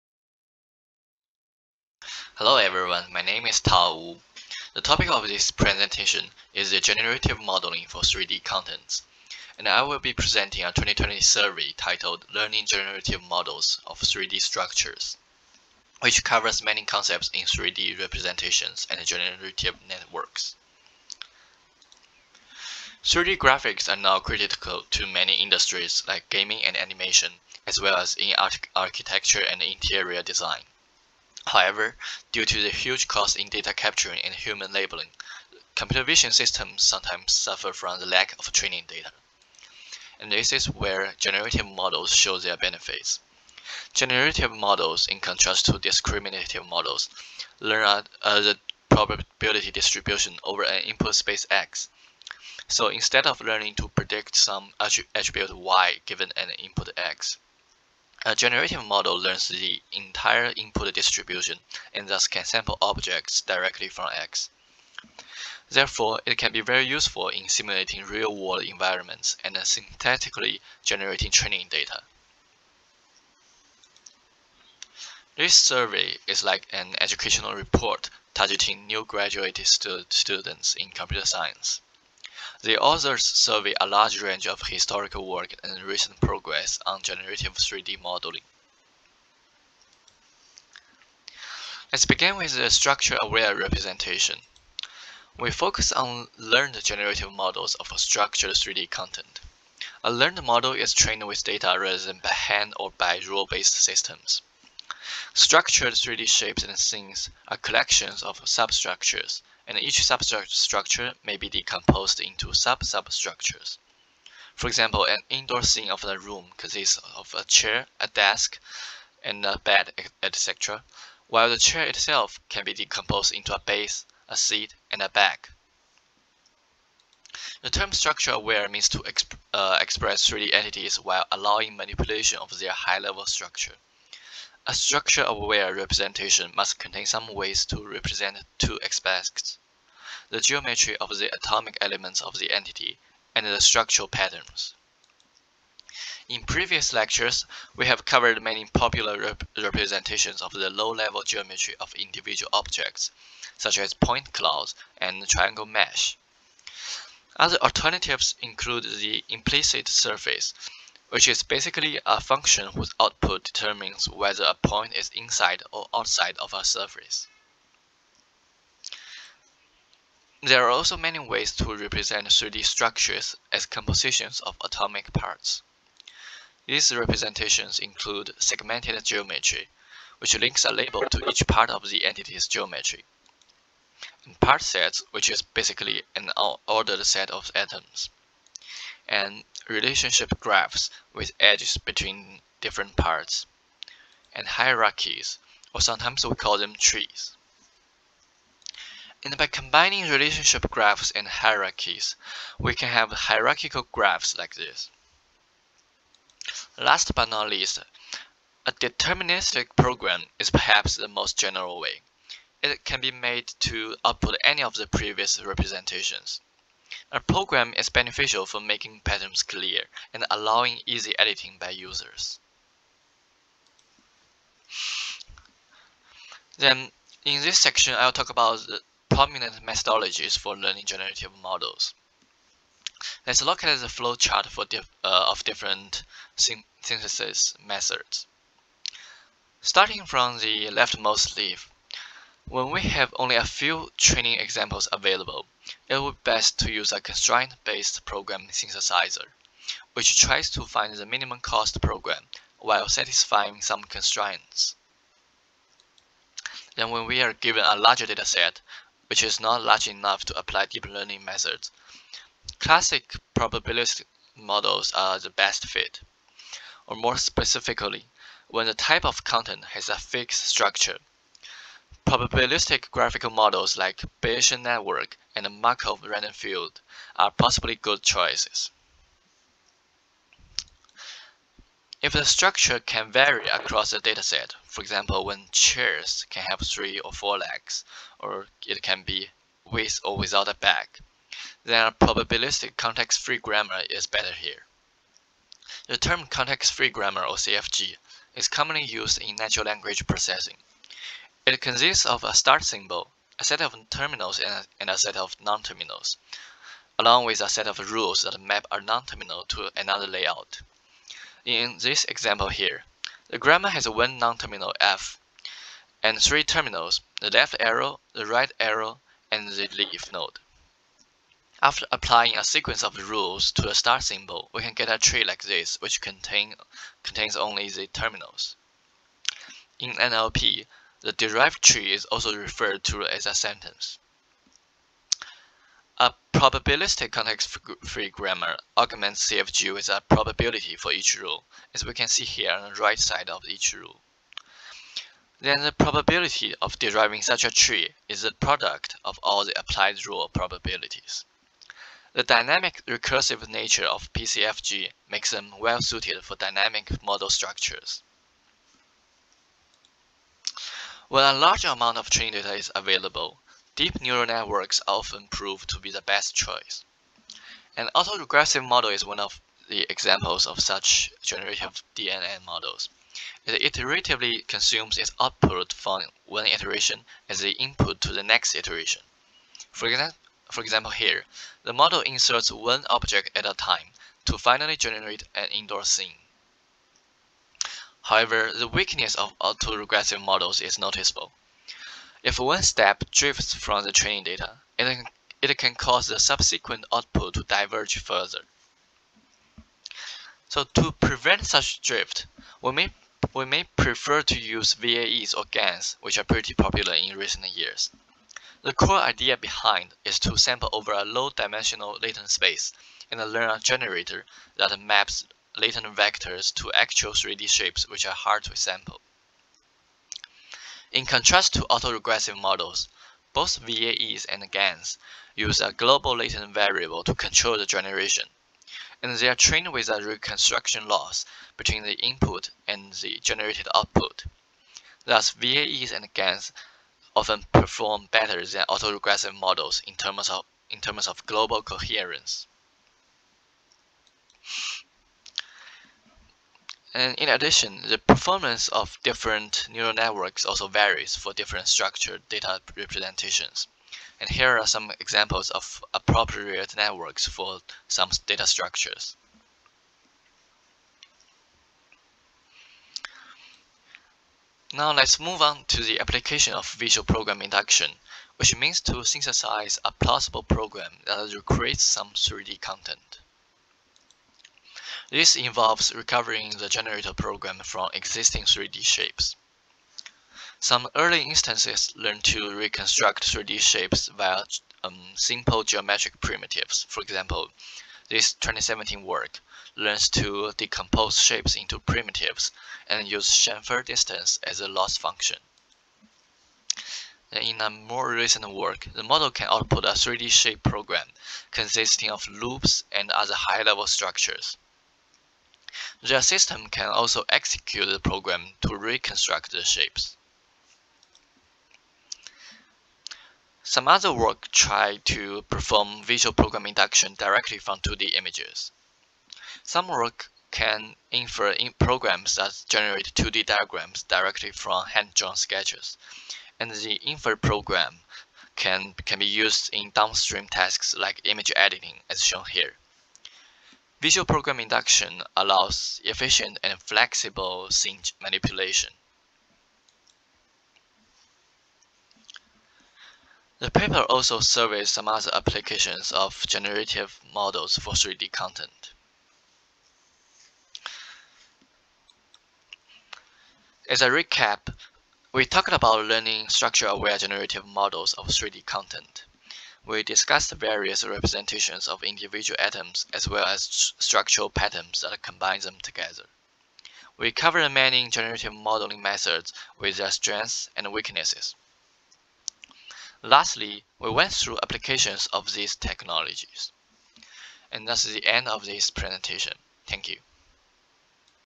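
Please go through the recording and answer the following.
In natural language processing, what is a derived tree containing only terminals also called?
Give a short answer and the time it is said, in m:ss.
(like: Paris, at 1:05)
a sentence, at 5:33.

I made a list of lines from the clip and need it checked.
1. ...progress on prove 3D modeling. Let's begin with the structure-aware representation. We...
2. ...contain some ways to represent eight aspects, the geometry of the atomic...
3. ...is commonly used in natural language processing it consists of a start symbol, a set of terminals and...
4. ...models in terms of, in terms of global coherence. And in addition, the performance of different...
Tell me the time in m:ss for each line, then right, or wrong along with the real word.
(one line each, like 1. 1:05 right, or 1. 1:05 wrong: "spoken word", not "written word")
1. 1:26 wrong: "generative", not "prove"
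2. 2:16 wrong: "two", not "eight"
3. 4:58 right
4. 7:19 right.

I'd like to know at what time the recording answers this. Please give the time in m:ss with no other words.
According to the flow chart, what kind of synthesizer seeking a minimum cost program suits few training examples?
4:07.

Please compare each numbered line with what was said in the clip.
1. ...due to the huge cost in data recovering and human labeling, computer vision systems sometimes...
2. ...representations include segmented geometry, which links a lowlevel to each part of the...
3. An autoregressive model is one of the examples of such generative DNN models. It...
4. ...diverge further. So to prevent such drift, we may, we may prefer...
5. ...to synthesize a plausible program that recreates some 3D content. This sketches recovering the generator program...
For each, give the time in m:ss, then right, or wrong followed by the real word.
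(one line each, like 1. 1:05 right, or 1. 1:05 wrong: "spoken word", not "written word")
1. 0:32 wrong: "capturing", not "recovering"
2. 2:56 wrong: "label", not "lowlevel"
3. 6:07 right
4. 6:37 right
5. 7:48 wrong: "involves", not "sketches".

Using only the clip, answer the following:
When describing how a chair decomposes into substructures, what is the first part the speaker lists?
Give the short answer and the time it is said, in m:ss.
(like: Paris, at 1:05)
a base, at 2:03.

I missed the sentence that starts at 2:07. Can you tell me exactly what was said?
The term structure-aware means to exp uh, express 3D entities while allowing manipulation of their high-level structure.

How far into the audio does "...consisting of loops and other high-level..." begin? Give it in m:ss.
8:21.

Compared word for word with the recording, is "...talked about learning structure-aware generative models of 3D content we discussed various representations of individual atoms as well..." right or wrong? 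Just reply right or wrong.
right.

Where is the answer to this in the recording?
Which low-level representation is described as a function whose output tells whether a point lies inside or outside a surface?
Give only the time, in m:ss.
2:39.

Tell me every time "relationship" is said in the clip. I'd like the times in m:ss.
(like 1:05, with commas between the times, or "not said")
3:09, 3:20.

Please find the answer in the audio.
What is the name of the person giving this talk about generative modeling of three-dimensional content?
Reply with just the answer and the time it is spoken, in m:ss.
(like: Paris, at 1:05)
Tao Wu, at 0:03.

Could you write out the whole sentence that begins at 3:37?
A program is beneficial for making patterns clear and allowing easy editing by users.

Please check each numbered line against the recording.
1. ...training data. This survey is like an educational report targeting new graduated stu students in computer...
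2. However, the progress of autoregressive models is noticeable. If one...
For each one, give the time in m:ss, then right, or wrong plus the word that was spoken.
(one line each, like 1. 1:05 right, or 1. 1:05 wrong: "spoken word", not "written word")
1. 1:11 right
2. 6:28 wrong: "weakness", not "progress".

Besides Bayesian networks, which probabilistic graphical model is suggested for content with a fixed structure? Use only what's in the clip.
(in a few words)
Markov random field.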